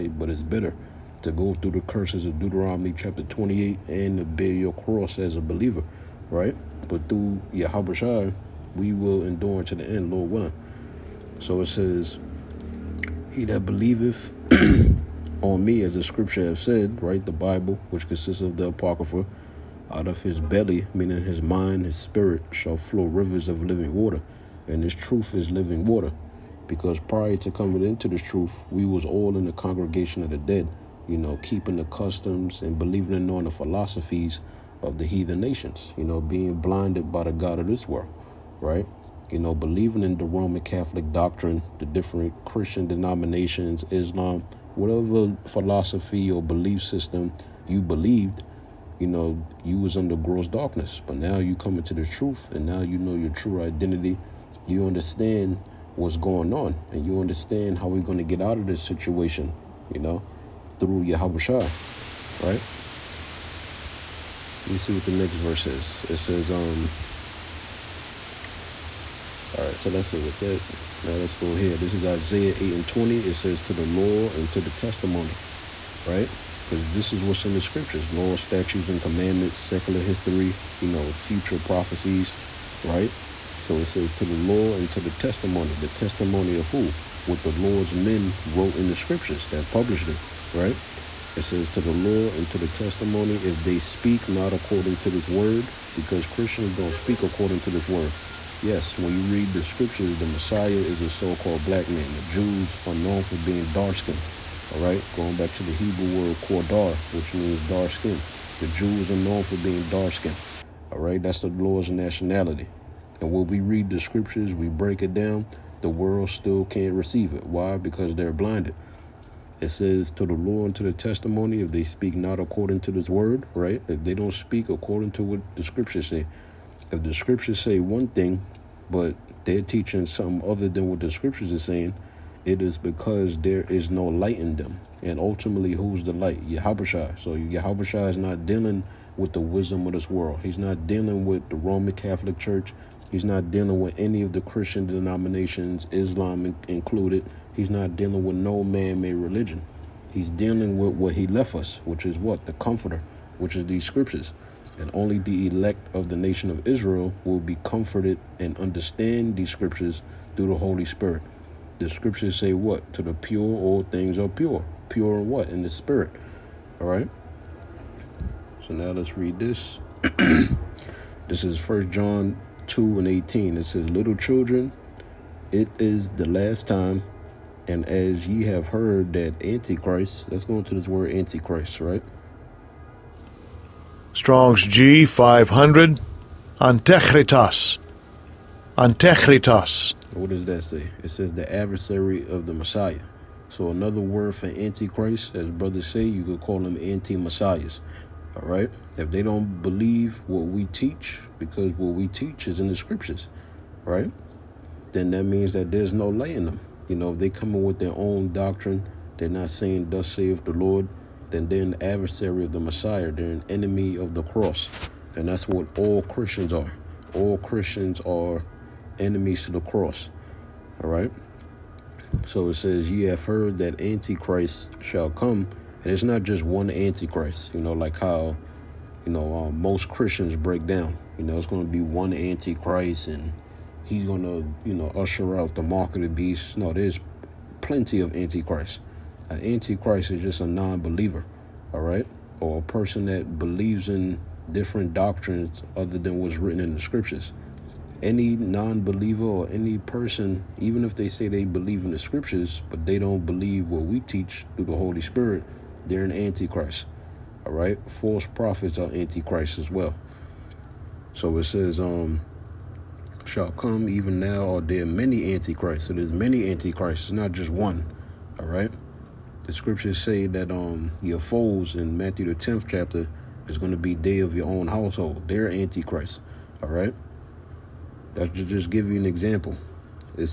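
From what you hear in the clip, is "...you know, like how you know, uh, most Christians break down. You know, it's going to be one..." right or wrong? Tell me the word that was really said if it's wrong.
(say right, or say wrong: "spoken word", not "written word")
right.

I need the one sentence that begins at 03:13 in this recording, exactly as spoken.
So another word for Antichrist, as brothers say, you could call them anti-Messiahs.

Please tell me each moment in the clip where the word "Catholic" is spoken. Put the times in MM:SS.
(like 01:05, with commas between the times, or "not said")
00:40, 02:21.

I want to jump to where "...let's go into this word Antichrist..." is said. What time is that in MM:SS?
03:00.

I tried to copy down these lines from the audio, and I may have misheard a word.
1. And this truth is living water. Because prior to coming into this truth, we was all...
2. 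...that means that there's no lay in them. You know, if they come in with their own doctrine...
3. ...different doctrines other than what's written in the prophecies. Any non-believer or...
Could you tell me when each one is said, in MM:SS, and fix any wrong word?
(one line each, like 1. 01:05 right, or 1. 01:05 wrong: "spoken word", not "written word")
1. 00:24 right
2. 03:25 right
3. 04:04 wrong: "scriptures", not "prophecies".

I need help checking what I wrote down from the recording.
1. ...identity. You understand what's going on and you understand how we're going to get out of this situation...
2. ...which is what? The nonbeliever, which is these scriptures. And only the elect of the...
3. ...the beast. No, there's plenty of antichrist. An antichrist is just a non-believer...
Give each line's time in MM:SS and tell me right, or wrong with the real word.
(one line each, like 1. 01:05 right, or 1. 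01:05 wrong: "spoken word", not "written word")
1. 00:53 right
2. 02:31 wrong: "comforter", not "nonbeliever"
3. 03:56 right.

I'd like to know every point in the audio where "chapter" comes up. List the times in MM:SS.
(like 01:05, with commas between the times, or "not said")
00:02, 04:32.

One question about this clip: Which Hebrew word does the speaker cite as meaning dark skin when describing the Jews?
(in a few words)
qadar.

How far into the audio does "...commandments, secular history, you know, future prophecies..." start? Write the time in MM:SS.
01:19.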